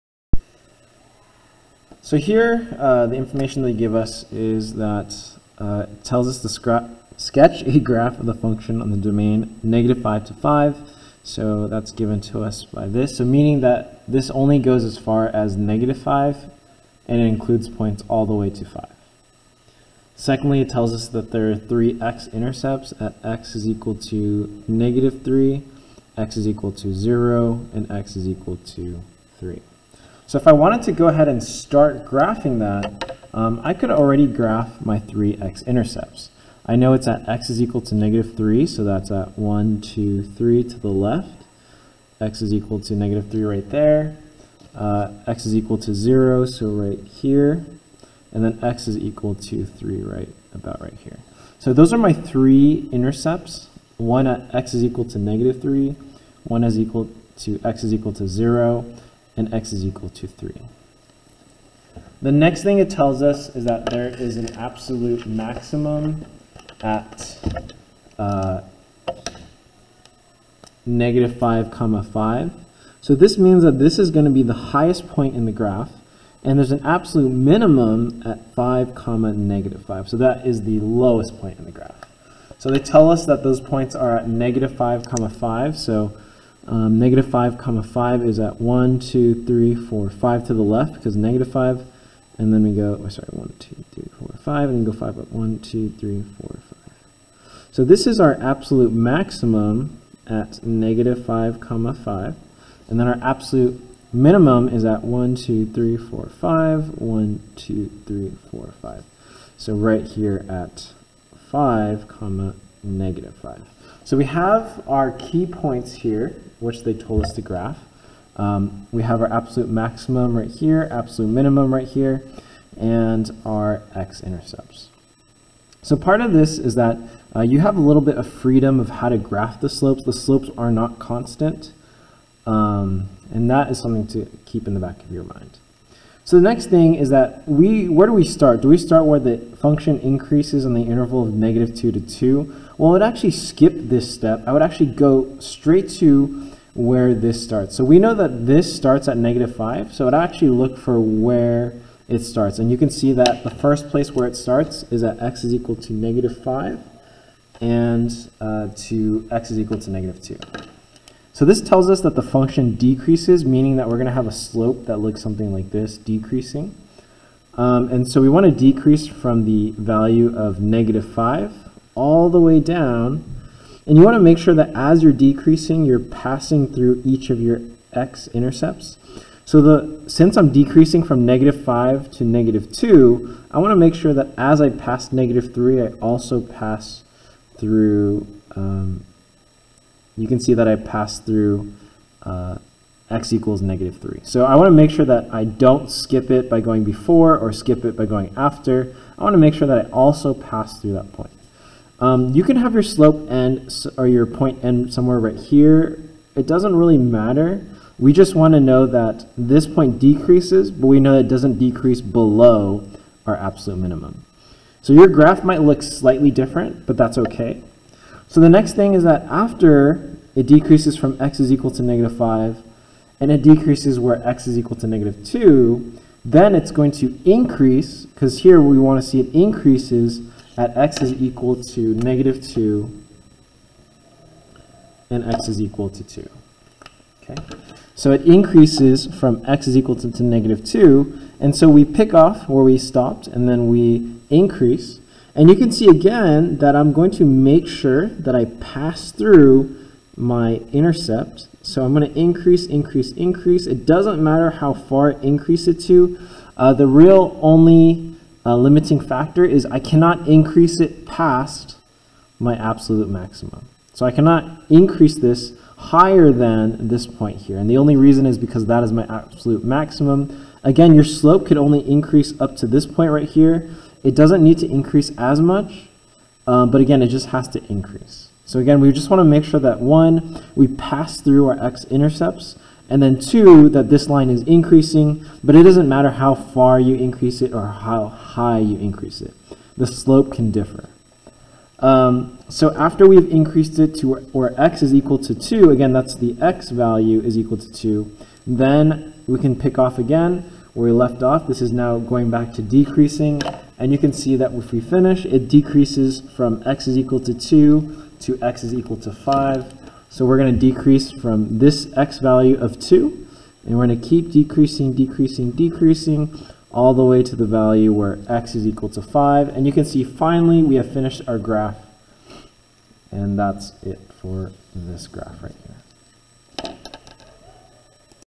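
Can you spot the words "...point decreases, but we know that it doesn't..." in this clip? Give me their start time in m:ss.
3:29.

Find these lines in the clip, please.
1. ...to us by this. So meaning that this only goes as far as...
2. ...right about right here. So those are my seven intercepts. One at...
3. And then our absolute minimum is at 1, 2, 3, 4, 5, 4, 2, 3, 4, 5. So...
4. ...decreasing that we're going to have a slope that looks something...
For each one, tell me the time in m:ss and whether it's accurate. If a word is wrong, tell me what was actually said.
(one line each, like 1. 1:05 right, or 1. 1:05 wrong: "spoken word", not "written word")
1. 0:12 right
2. 0:50 wrong: "three", not "seven"
3. 1:42 wrong: "1", not "4"
4. 2:43 wrong: "meaning", not "decreasing".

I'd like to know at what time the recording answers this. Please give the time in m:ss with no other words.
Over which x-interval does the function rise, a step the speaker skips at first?
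2:21.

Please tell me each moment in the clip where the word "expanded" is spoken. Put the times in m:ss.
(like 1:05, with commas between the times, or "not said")
not said.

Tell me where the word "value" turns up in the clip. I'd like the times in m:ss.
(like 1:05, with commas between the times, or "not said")
2:49, 4:56, 5:12, 5:17.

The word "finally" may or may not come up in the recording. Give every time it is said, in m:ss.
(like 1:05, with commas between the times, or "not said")
5:20.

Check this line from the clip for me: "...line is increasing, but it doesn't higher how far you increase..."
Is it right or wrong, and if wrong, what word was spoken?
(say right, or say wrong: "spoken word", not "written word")
wrong: "matter", not "higher".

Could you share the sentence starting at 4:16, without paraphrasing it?
Uh, the real only uh, limiting factor is I cannot increase it past my absolute maximum.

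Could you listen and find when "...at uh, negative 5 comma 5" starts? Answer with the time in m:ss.
1:06.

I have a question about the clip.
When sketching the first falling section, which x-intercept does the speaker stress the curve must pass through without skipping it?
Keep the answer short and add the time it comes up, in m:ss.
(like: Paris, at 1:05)
x = -3, at 3:13.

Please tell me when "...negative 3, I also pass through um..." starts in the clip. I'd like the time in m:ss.
3:05.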